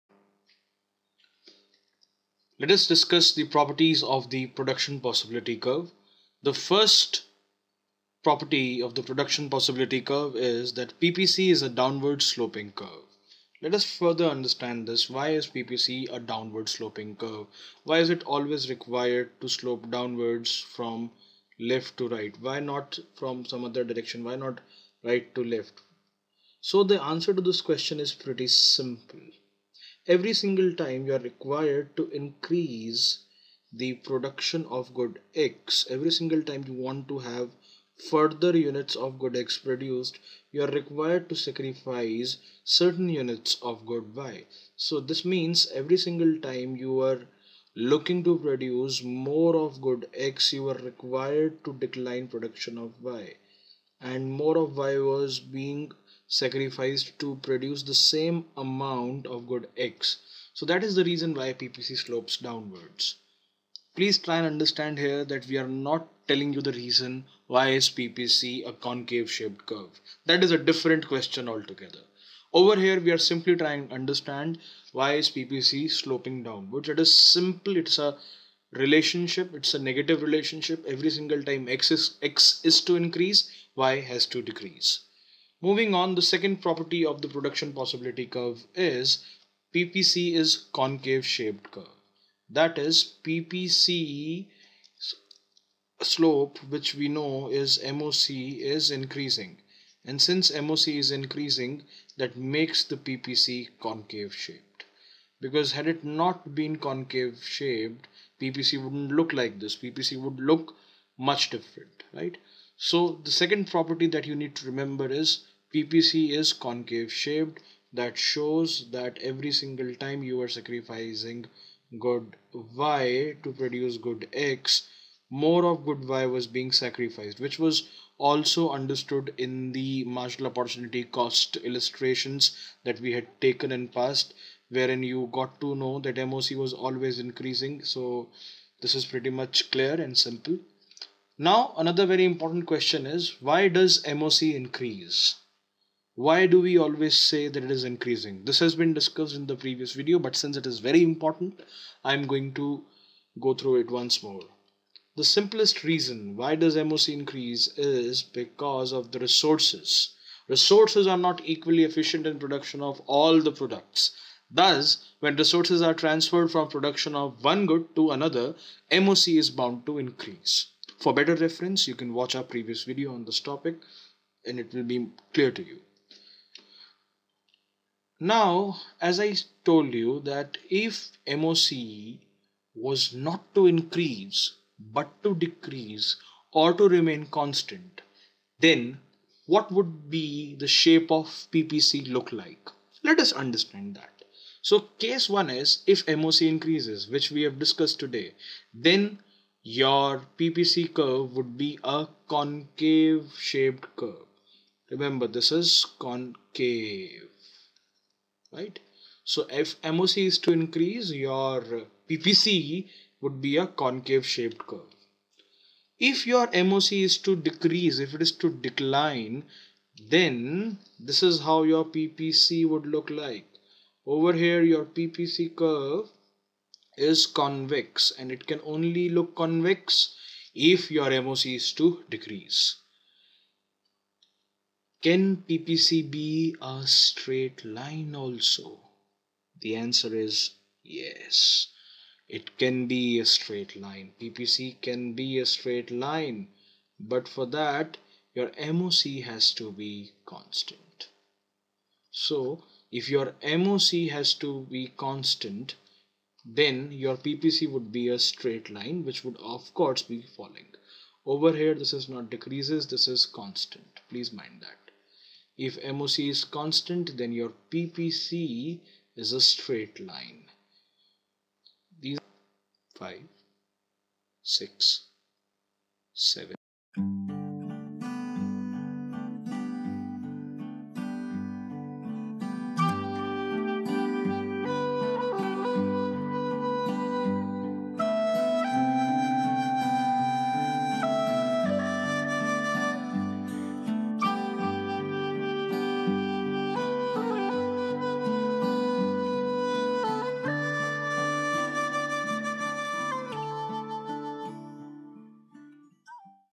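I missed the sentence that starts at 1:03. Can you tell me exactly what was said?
Please try and understand here that we are not telling you the reason why is PPC a concave shaped curve.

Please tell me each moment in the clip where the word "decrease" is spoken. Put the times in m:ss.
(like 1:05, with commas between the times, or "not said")
1:24, 3:05, 3:37, 3:52, 4:22.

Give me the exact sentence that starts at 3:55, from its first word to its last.
Can PPC be a straight line also?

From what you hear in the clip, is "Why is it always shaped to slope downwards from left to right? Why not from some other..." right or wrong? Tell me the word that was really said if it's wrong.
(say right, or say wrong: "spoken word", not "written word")
wrong: "required", not "shaped".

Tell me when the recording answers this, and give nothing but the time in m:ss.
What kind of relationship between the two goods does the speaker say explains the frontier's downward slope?
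1:19.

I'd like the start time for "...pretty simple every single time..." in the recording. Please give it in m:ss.
0:28.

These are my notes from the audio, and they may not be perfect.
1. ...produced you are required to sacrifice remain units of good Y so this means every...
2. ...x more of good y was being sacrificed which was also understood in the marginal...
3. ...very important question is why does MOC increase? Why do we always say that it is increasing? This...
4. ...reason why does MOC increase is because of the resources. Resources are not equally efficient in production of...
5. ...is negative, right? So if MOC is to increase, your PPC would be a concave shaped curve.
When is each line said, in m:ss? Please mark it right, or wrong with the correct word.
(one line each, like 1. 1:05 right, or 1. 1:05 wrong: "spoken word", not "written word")
1. 0:39 wrong: "certain", not "remain"
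2. 2:04 right
3. 2:22 right
4. 2:35 right
5. 3:25 wrong: "concave", not "negative".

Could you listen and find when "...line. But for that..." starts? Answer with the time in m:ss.
4:05.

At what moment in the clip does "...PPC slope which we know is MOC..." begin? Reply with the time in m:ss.
1:33.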